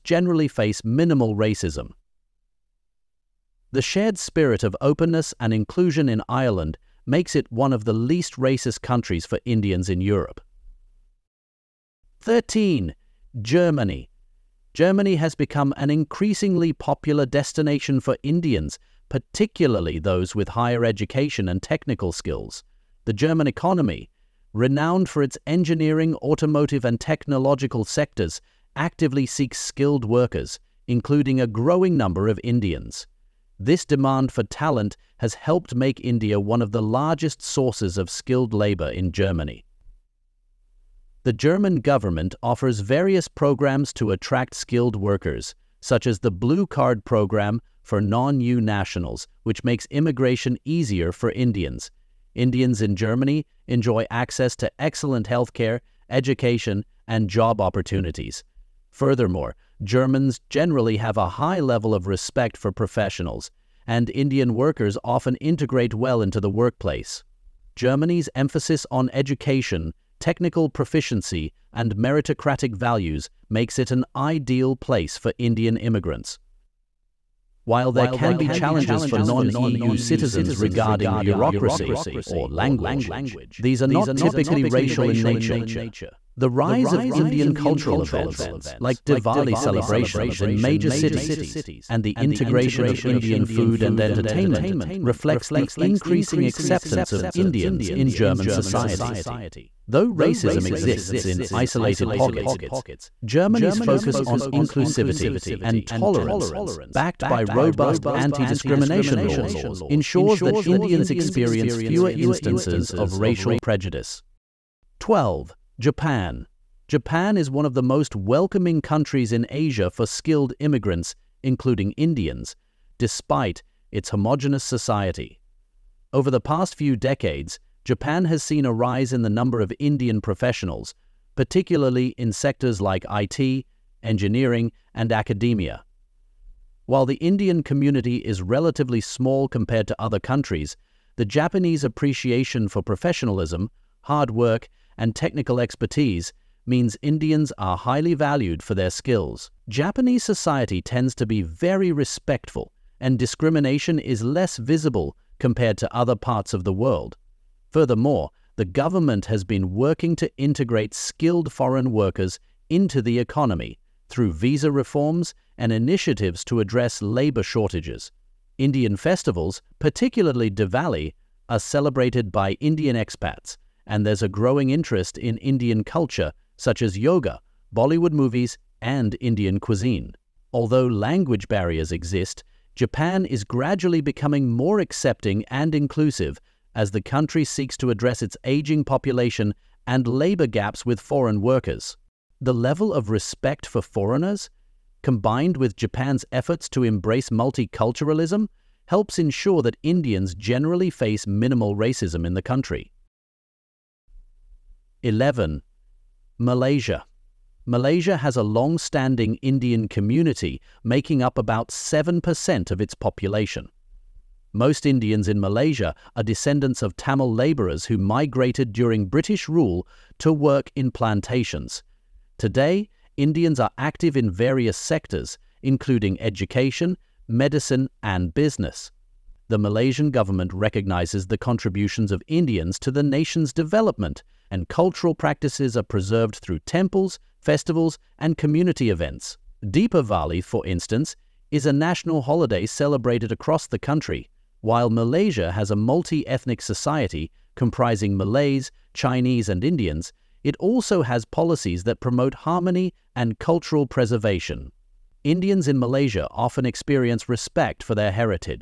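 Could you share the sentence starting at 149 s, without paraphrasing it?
Japanese society tends to be very respectful, and discrimination is less visible compared to other parts of the world.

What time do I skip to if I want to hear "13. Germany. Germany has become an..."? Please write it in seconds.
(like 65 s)
12 s.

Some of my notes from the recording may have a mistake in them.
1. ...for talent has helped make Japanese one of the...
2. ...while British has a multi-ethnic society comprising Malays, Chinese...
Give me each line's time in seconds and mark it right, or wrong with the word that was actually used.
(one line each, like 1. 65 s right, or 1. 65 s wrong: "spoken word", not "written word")
1. 34 s wrong: "India", not "Japanese"
2. 244 s wrong: "Malaysia", not "British".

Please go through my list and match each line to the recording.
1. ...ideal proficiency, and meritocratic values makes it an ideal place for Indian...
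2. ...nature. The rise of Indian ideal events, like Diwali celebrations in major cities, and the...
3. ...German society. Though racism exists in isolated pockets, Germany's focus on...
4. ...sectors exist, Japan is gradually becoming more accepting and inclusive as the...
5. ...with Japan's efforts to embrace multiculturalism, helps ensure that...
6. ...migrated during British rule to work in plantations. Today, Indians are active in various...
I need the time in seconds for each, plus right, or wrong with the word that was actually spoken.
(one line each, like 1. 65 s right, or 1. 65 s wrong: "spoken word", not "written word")
1. 70 s wrong: "technical", not "ideal"
2. 85 s wrong: "cultural", not "ideal"
3. 98 s right
4. 181 s wrong: "barriers", not "sectors"
5. 195 s right
6. 217 s right.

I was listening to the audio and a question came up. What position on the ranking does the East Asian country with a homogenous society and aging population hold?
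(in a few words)
12.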